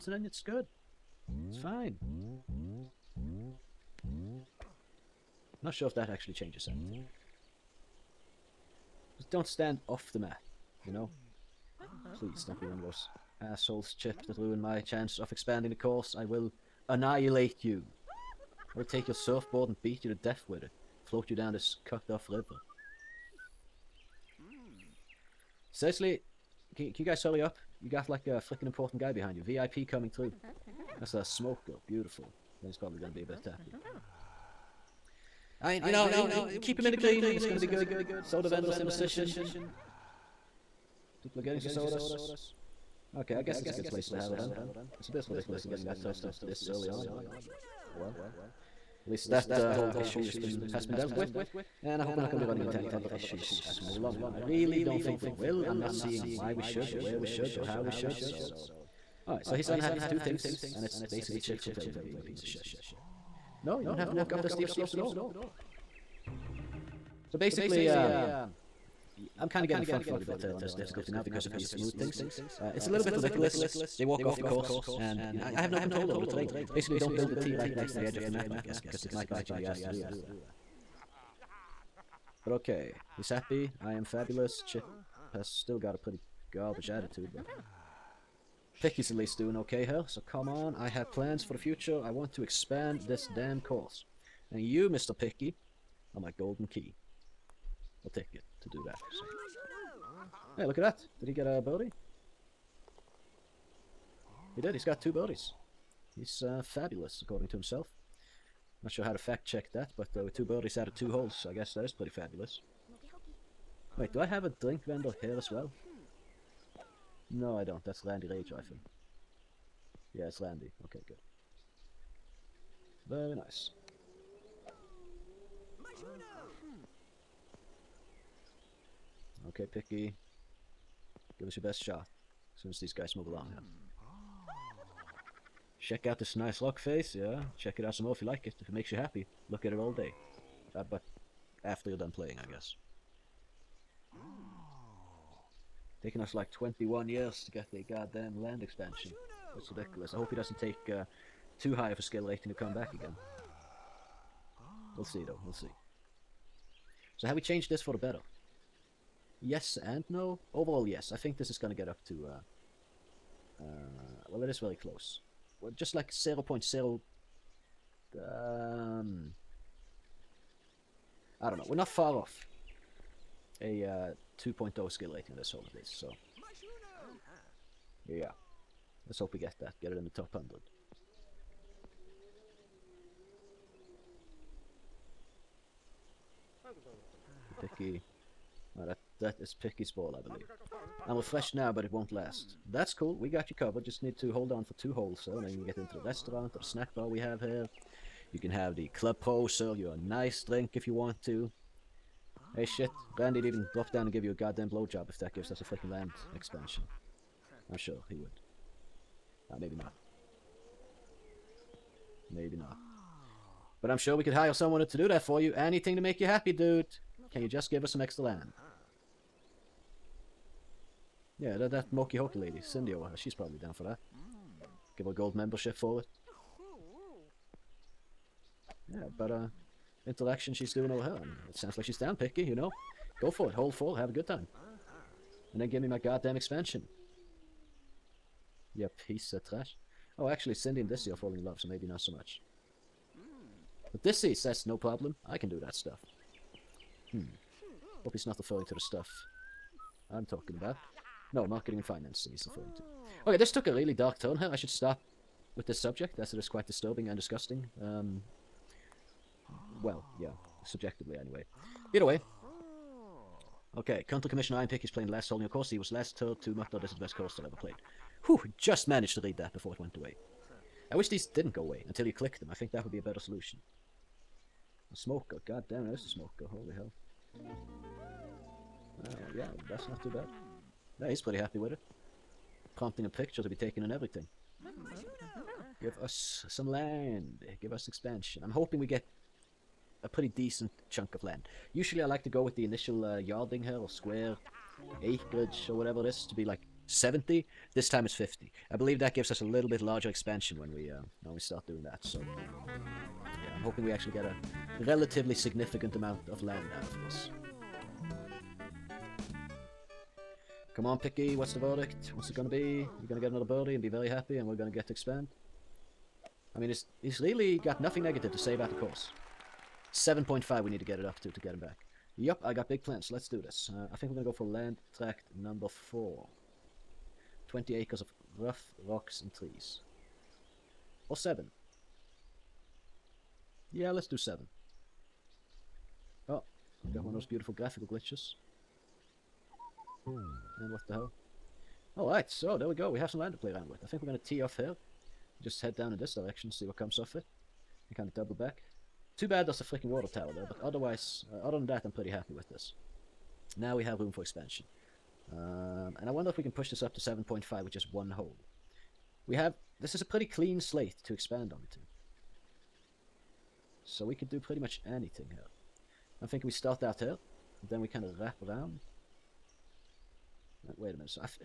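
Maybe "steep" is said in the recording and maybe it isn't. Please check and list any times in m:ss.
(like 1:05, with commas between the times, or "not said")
1:04.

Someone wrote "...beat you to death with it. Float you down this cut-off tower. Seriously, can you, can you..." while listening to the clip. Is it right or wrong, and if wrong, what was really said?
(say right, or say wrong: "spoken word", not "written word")
wrong: "river", not "tower".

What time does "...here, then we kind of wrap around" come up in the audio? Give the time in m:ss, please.
6:06.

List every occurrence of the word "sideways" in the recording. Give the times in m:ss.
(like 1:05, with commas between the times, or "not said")
not said.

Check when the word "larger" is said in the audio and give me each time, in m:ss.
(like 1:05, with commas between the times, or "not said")
4:59.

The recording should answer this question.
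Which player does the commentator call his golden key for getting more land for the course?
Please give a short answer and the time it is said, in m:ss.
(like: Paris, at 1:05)
Mr. Picky, at 1:34.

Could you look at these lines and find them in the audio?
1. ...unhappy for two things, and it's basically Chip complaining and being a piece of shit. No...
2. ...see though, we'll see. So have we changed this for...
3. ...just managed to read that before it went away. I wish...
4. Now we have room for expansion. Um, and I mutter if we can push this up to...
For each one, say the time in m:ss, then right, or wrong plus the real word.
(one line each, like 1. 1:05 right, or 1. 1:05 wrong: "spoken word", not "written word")
1. 0:59 right
2. 2:35 right
3. 4:28 right
4. 5:53 wrong: "wonder", not "mutter".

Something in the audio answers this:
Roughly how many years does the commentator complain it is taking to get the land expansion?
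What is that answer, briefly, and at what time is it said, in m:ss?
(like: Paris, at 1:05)
21, at 2:26.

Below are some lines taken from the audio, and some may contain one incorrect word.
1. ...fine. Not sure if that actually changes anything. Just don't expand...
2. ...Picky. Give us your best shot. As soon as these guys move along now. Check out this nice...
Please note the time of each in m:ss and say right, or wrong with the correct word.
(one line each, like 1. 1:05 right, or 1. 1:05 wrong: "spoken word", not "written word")
1. 0:01 wrong: "stand", not "expand"
2. 2:09 right.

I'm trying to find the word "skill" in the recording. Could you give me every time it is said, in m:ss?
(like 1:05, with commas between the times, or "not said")
2:32, 2:54.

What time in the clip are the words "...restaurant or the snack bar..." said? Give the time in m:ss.
3:16.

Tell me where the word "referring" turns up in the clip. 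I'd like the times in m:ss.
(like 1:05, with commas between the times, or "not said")
4:08, 4:12.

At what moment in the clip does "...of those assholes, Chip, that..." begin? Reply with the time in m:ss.
0:12.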